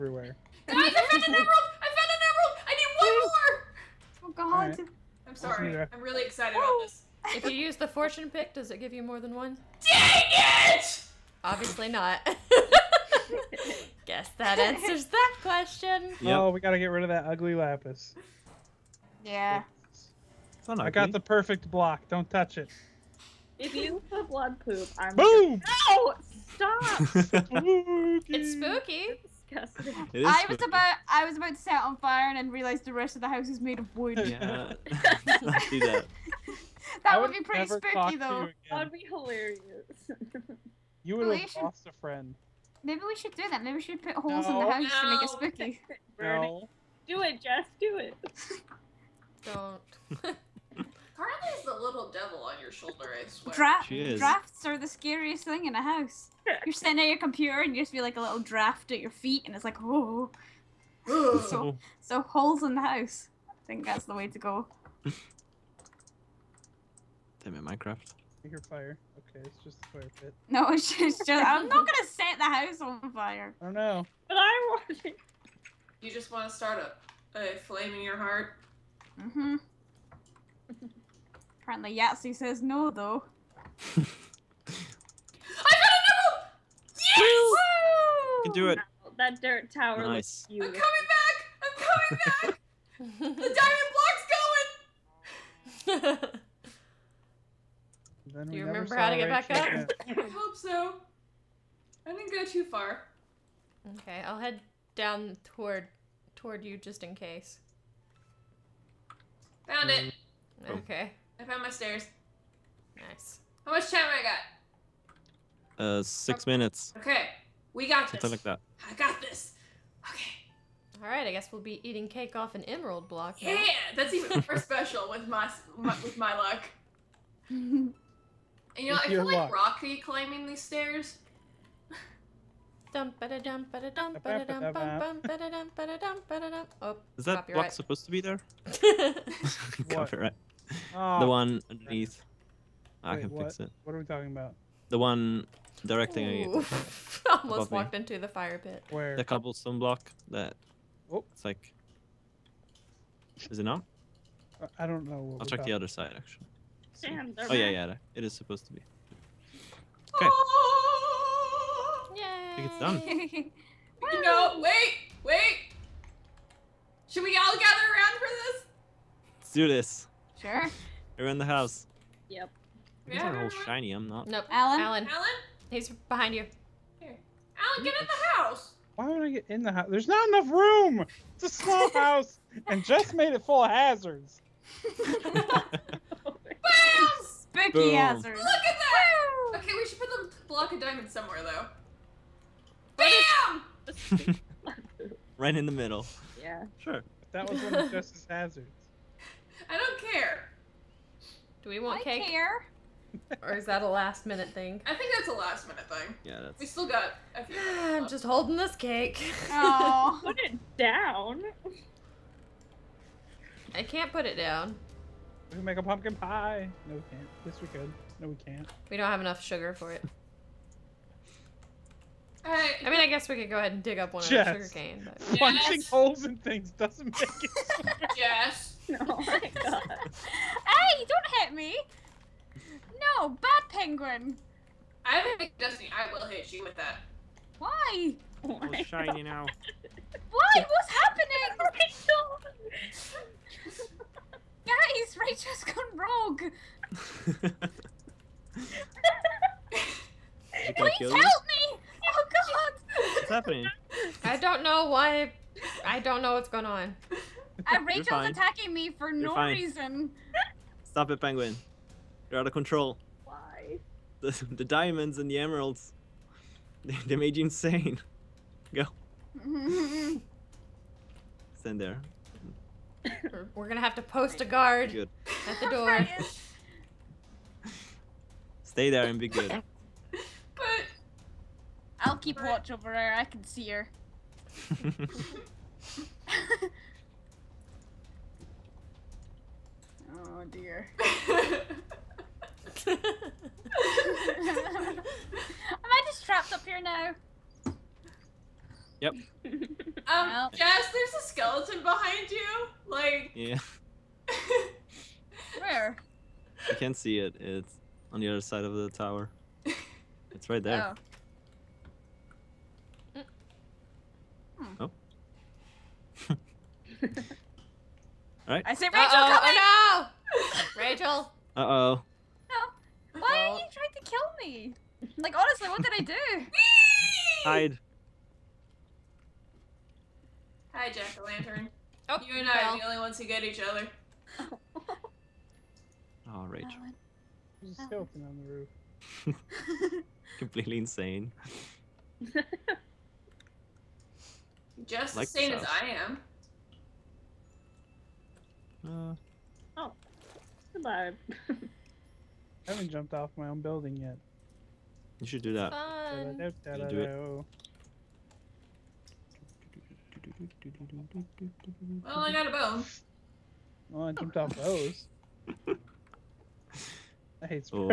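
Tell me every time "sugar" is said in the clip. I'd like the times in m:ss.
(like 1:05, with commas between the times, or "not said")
3:39, 3:44.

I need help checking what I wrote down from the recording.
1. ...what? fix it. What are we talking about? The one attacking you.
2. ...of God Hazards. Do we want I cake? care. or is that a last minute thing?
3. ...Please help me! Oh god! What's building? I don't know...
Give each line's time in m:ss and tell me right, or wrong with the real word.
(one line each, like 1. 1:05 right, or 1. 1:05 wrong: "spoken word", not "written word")
1. 2:23 wrong: "directing", not "attacking"
2. 3:17 wrong: "Justice", not "God"
3. 4:10 wrong: "happening", not "building".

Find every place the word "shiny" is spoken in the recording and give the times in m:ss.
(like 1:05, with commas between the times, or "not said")
2:53, 3:58.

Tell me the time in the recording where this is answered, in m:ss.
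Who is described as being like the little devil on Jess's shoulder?
0:51.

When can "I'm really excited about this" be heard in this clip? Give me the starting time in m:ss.
0:05.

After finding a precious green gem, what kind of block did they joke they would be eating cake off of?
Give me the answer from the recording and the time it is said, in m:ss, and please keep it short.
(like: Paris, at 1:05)
An emerald block, at 2:02.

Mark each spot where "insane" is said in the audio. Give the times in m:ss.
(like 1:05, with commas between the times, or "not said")
4:27, 5:40.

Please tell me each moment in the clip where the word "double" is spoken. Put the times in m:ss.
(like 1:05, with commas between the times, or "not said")
not said.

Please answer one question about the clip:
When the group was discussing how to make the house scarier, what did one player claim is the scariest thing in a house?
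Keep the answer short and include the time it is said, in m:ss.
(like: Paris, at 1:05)
Drafts, at 0:54.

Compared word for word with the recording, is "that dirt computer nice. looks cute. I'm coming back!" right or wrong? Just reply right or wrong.
wrong.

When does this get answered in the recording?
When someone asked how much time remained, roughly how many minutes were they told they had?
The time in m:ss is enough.
1:56.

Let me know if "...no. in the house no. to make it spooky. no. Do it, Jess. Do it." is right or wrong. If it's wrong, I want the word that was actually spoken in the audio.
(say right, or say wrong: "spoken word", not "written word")
right.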